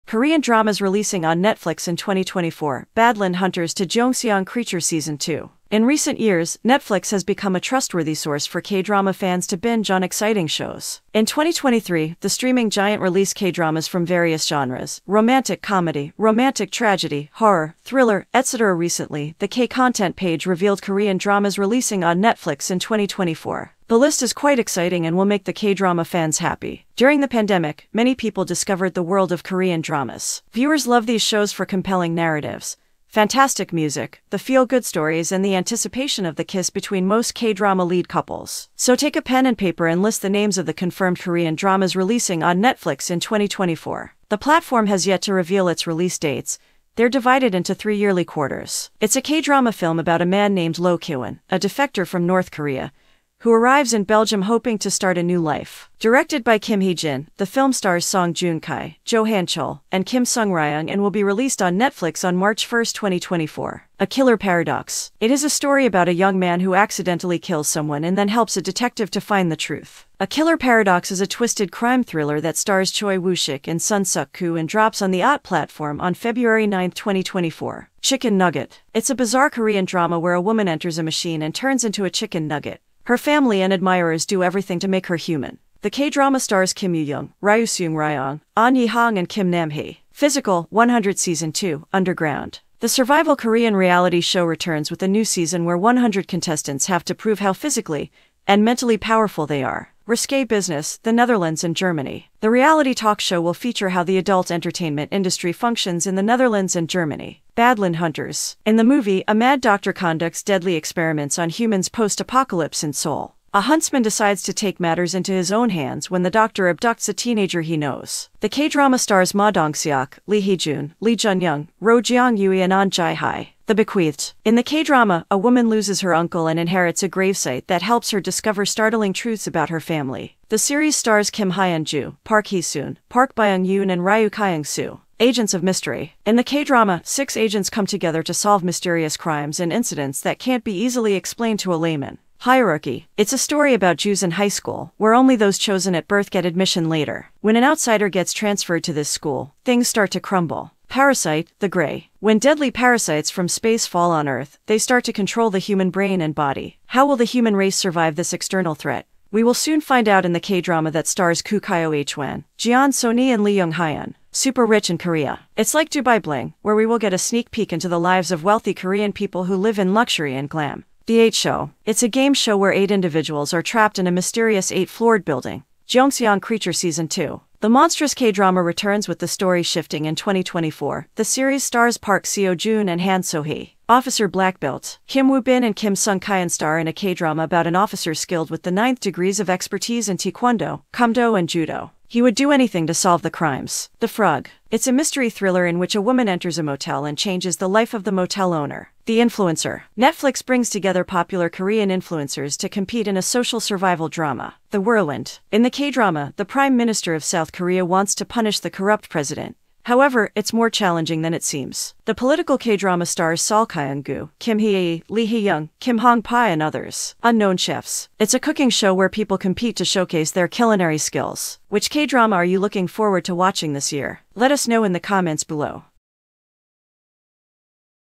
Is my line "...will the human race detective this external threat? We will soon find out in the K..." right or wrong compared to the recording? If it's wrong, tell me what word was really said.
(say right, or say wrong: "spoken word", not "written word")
wrong: "survive", not "detective".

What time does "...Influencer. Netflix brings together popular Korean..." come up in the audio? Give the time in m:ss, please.
3:19.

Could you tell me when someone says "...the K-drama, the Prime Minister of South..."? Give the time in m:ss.
3:25.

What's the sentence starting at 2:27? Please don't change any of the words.
When an outsider gets transferred to this school, things start to crumble.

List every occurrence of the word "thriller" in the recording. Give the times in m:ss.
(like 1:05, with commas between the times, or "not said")
0:17, 1:12, 3:15.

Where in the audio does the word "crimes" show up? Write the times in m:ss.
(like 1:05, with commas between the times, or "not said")
1:11, 2:19, 3:13.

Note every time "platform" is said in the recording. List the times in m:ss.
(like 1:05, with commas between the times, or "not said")
0:44, 1:15.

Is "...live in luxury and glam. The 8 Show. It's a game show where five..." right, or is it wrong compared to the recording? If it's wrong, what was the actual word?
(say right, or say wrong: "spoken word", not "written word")
wrong: "eight", not "five".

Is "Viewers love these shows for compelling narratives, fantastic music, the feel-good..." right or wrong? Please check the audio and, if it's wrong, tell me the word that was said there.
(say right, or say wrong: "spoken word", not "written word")
right.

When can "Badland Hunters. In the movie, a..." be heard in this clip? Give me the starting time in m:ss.
1:47.